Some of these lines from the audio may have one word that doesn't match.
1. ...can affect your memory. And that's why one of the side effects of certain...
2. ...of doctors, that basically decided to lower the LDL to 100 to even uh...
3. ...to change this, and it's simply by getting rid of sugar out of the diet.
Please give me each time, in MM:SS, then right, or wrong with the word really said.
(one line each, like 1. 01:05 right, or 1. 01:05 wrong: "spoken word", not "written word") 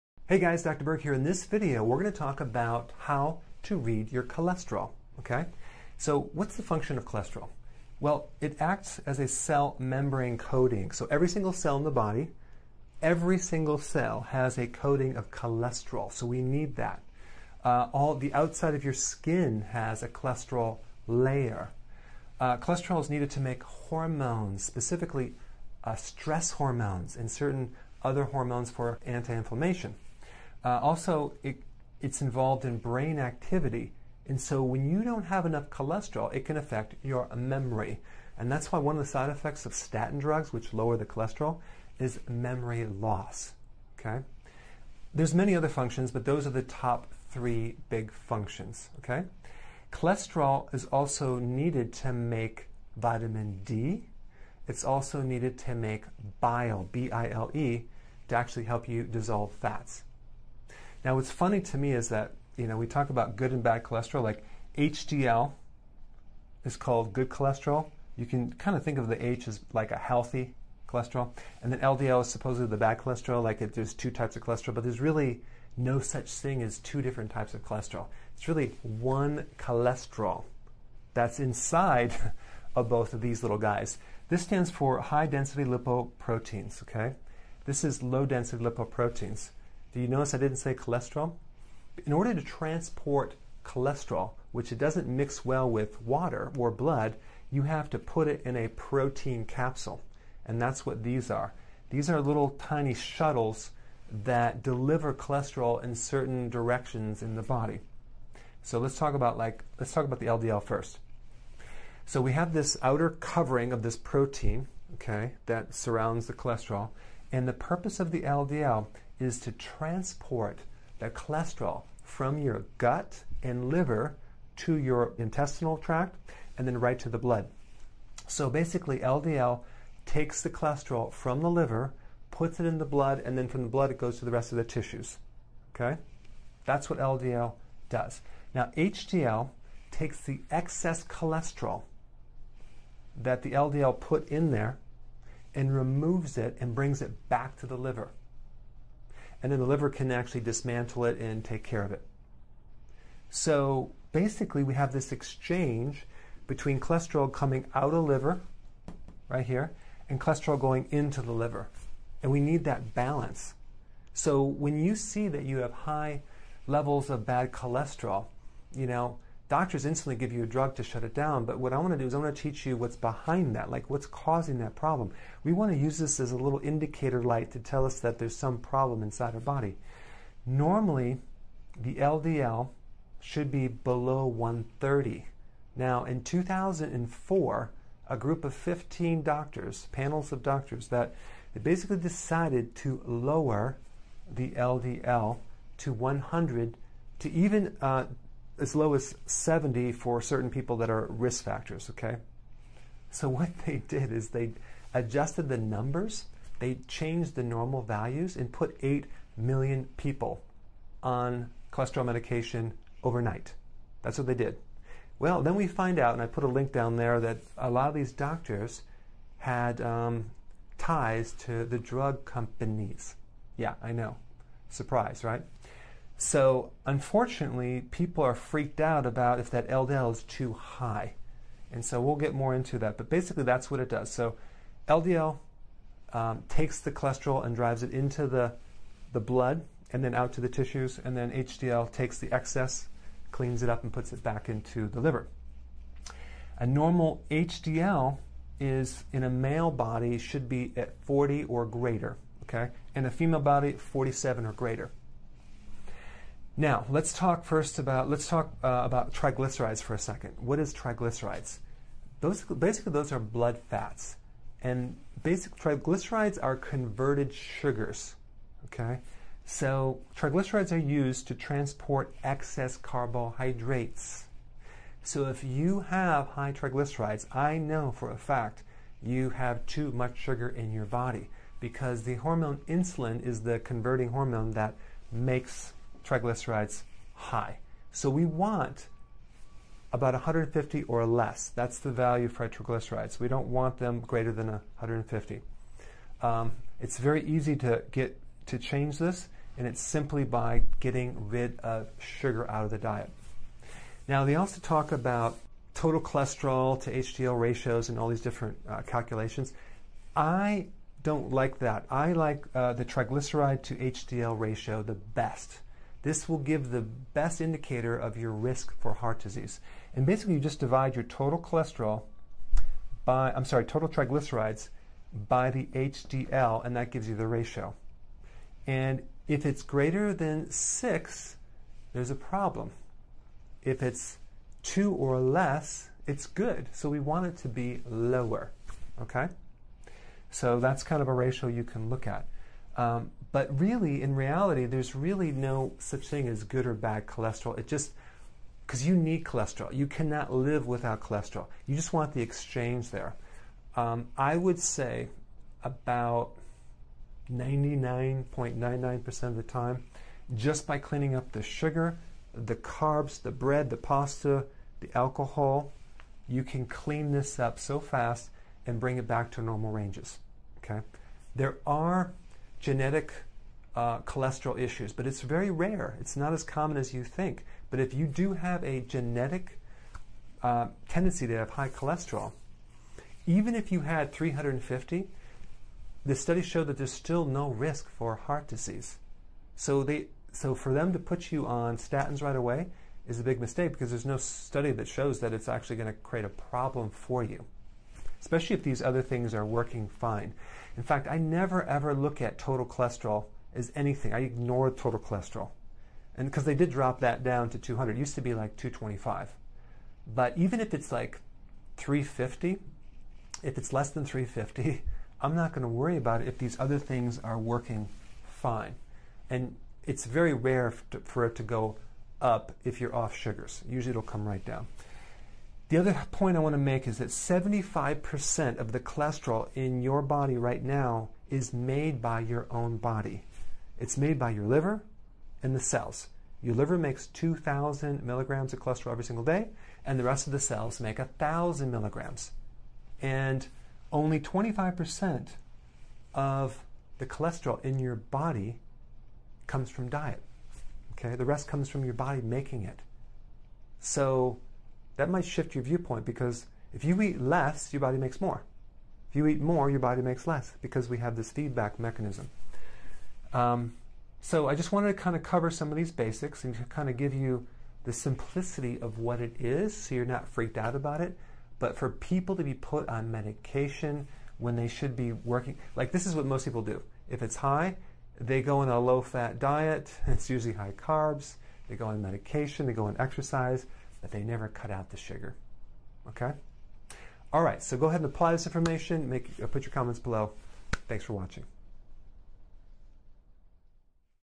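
1. 00:36 wrong: "statin", not "certain"
2. 03:10 right
3. 04:58 right.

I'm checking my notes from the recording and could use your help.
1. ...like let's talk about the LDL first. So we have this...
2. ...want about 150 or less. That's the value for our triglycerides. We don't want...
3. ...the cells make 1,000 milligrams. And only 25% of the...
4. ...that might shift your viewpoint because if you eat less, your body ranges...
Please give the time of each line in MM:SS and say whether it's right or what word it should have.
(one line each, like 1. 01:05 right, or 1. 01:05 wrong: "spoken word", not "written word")
1. 01:49 right
2. 04:48 right
3. 07:20 right
4. 07:34 wrong: "makes", not "ranges".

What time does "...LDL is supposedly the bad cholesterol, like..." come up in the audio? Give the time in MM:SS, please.
01:11.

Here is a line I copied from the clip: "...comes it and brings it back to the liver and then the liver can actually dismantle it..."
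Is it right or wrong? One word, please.
wrong.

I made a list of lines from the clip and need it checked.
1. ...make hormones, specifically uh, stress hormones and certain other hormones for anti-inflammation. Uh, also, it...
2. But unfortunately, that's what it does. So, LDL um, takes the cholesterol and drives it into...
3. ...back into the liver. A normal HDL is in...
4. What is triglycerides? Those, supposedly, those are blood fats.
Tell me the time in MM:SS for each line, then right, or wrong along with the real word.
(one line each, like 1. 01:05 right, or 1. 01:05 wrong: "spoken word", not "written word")
1. 00:23 right
2. 03:52 wrong: "basically", not "unfortunately"
3. 04:04 right
4. 04:20 wrong: "basically", not "supposedly".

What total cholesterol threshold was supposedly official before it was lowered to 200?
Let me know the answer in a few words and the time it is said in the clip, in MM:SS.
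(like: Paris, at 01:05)
225, at 06:48.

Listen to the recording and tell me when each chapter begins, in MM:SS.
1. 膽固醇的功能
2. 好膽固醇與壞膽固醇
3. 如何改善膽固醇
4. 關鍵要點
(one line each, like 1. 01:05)
1. 00:10
2. 01:00
3. 05:44
4. 07:42.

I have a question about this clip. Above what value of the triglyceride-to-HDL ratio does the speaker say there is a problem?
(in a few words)
6.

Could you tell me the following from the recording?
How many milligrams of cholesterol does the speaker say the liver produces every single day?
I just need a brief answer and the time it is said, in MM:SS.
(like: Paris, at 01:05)
2,000 milligrams, at 07:17.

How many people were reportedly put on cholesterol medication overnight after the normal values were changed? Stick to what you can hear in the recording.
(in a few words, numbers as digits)
8 million.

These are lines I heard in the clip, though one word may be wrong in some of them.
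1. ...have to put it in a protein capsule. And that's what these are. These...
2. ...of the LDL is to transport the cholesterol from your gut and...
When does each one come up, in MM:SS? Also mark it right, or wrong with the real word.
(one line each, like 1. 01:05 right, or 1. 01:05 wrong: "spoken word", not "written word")
1. 01:37 right
2. 01:57 right.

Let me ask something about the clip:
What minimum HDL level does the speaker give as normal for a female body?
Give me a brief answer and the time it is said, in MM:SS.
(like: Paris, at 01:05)
47, at 04:13.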